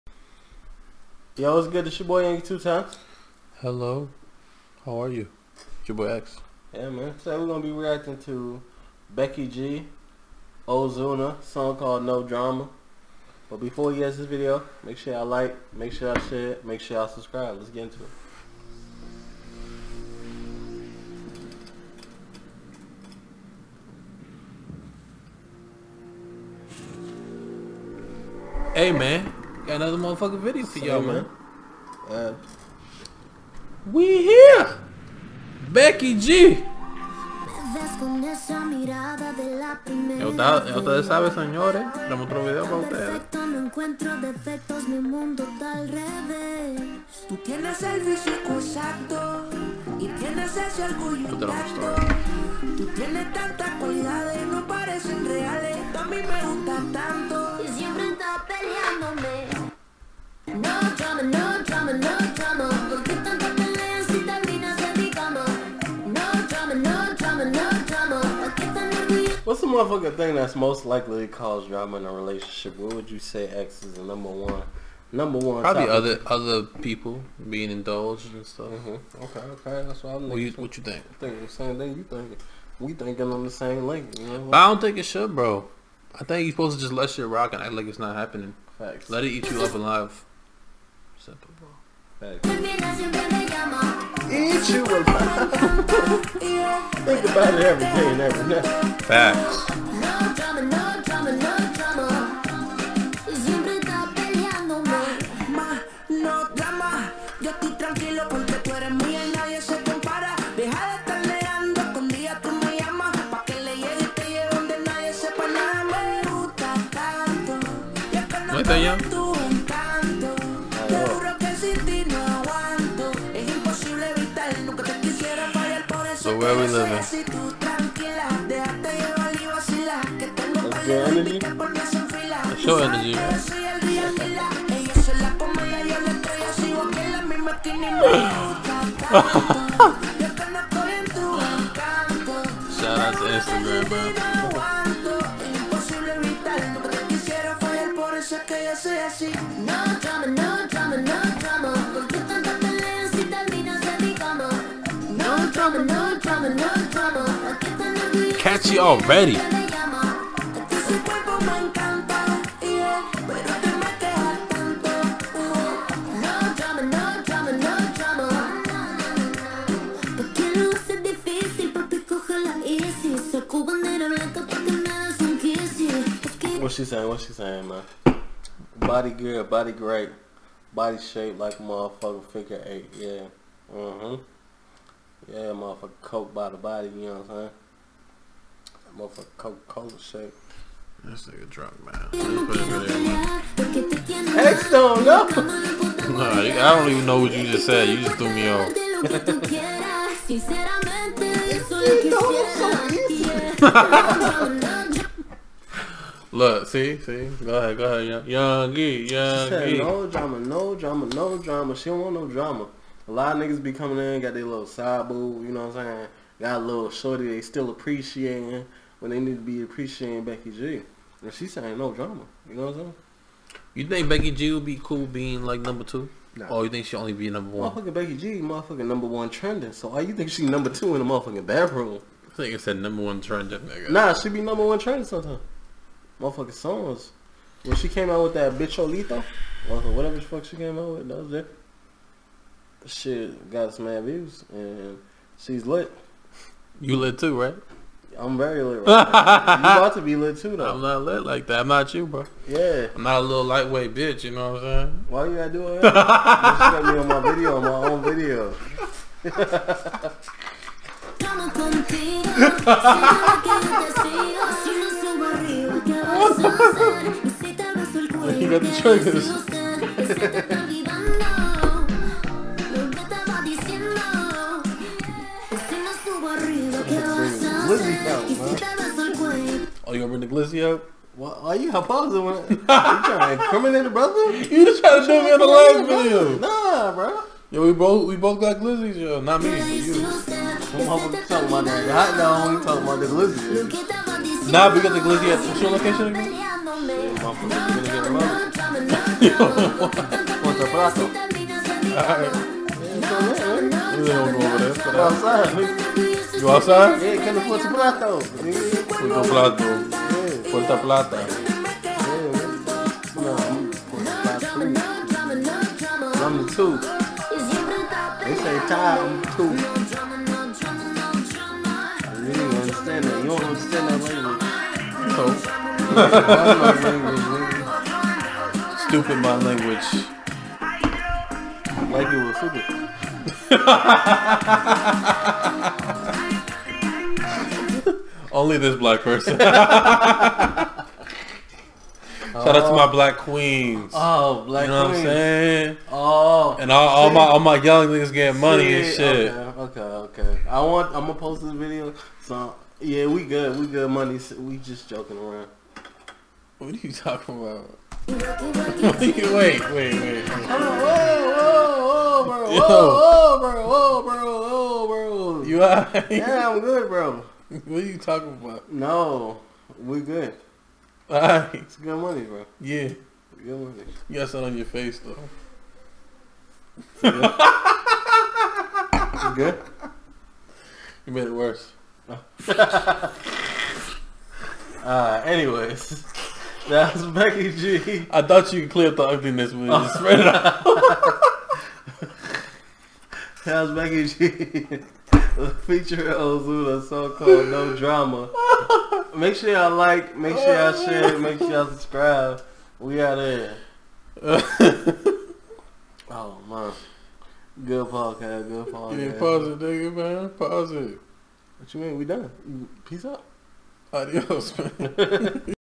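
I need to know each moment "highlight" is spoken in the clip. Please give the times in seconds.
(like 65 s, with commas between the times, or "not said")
not said.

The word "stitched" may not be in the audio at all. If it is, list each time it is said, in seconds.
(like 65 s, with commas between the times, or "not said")
not said.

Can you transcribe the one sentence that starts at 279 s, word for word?
Oh, you gonna bring the glizzy up?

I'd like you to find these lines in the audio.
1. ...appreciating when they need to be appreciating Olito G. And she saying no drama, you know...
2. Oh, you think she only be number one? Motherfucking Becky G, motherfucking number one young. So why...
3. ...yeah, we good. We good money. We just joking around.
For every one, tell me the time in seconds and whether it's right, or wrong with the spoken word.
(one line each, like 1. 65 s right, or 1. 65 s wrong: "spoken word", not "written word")
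1. 217 s wrong: "Becky", not "Olito"
2. 226 s wrong: "trending", not "young"
3. 352 s right.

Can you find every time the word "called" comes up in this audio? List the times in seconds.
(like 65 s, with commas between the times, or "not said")
11 s, 397 s.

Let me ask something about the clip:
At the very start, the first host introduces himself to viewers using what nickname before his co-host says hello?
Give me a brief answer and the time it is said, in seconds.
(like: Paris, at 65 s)
Yungie Two Times, at 2 s.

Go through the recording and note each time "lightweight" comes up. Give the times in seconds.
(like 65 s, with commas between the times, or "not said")
253 s.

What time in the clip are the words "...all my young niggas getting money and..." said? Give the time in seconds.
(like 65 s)
347 s.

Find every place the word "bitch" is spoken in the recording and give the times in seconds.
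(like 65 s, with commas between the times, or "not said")
238 s, 253 s.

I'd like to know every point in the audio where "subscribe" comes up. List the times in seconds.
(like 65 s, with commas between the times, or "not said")
17 s, 401 s.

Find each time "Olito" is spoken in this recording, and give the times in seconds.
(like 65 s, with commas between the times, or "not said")
238 s.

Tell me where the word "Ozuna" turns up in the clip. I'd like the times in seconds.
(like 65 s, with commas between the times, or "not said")
10 s, 396 s.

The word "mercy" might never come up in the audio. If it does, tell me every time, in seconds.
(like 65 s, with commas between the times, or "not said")
not said.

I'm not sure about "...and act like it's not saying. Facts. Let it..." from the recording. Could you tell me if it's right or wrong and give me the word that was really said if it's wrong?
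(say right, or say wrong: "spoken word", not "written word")
wrong: "happening", not "saying".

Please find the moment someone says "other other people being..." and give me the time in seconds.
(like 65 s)
75 s.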